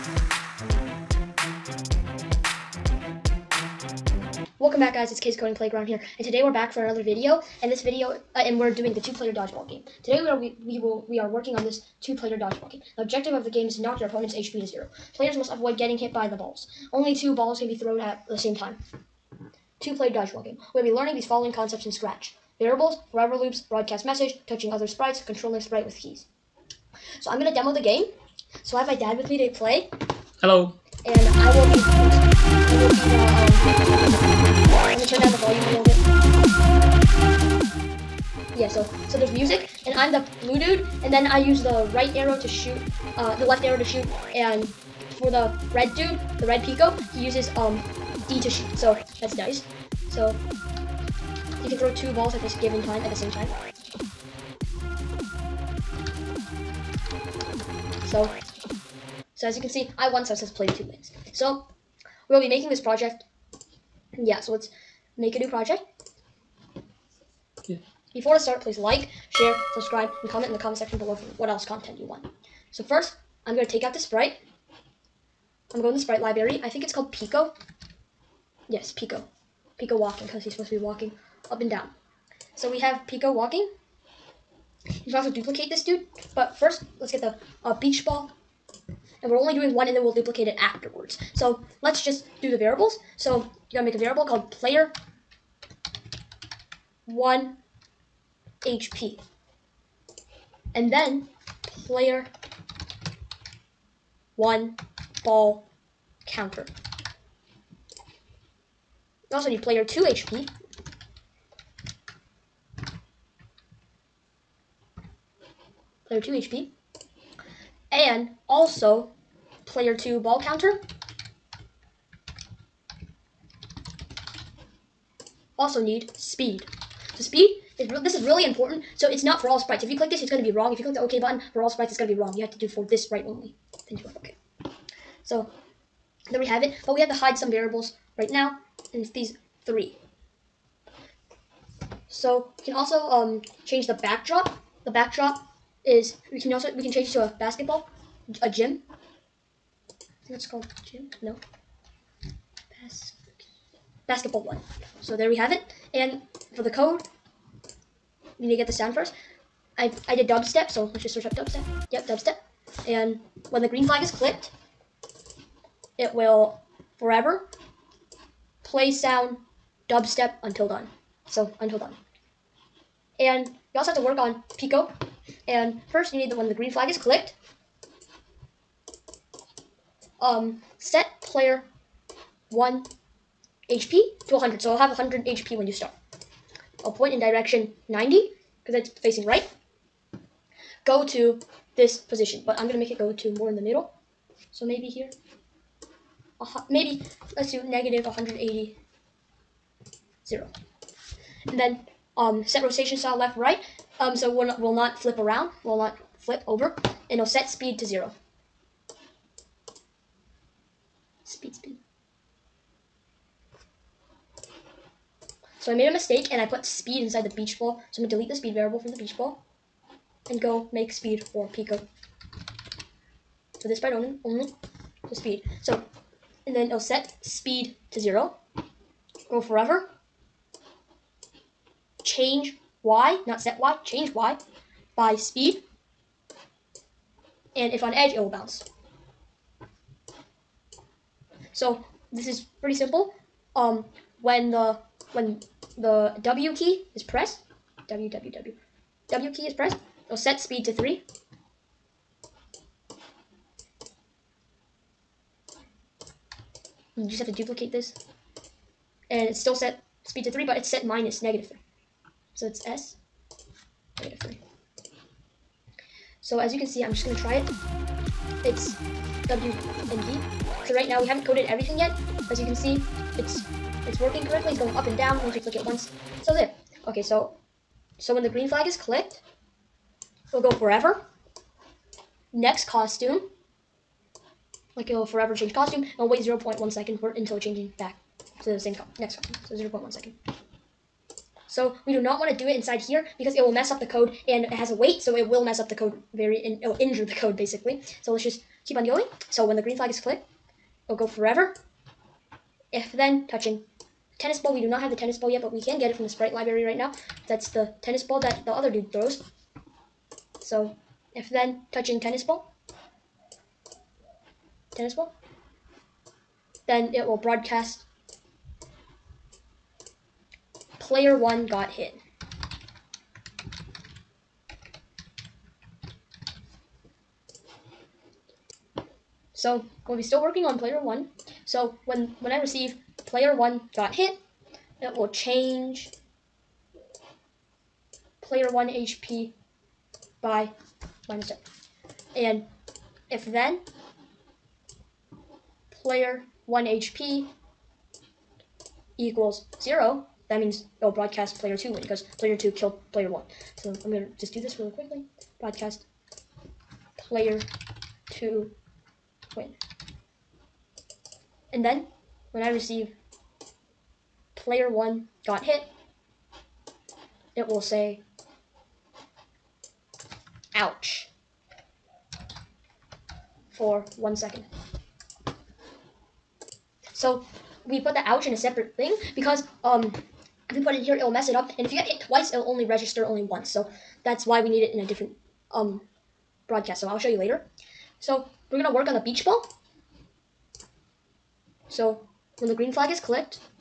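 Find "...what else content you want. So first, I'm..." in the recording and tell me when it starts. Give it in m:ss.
1:11.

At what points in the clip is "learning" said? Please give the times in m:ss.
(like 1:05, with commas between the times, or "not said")
0:20.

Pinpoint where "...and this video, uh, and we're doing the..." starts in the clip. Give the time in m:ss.
0:07.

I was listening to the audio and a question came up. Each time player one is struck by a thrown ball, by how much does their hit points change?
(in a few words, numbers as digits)
-2.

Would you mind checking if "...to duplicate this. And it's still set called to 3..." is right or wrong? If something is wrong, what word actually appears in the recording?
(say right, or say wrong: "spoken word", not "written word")
wrong: "speed", not "called".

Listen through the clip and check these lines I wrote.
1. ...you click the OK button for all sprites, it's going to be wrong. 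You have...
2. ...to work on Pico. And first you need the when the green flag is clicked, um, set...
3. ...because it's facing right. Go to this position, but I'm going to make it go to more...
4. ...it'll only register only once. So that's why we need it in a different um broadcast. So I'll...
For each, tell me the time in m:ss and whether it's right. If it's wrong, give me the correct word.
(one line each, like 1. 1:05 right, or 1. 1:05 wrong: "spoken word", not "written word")
1. 2:10 right
2. 2:53 right
3. 3:08 right
4. 6:22 right.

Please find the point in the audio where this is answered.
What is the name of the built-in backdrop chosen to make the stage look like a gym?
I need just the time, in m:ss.
2:34.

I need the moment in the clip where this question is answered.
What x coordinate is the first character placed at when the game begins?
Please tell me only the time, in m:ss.
3:17.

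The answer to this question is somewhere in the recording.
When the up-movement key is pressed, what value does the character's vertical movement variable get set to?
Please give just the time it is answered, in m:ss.
4:10.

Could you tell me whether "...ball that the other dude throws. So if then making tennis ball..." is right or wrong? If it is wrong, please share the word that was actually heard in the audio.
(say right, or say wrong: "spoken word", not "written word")
wrong: "touching", not "making".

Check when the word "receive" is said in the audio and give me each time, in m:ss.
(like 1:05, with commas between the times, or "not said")
5:32, 6:02.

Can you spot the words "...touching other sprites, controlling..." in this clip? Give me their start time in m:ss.
0:24.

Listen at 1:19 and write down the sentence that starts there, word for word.
Pico walking, because he's supposed to be walking up and down.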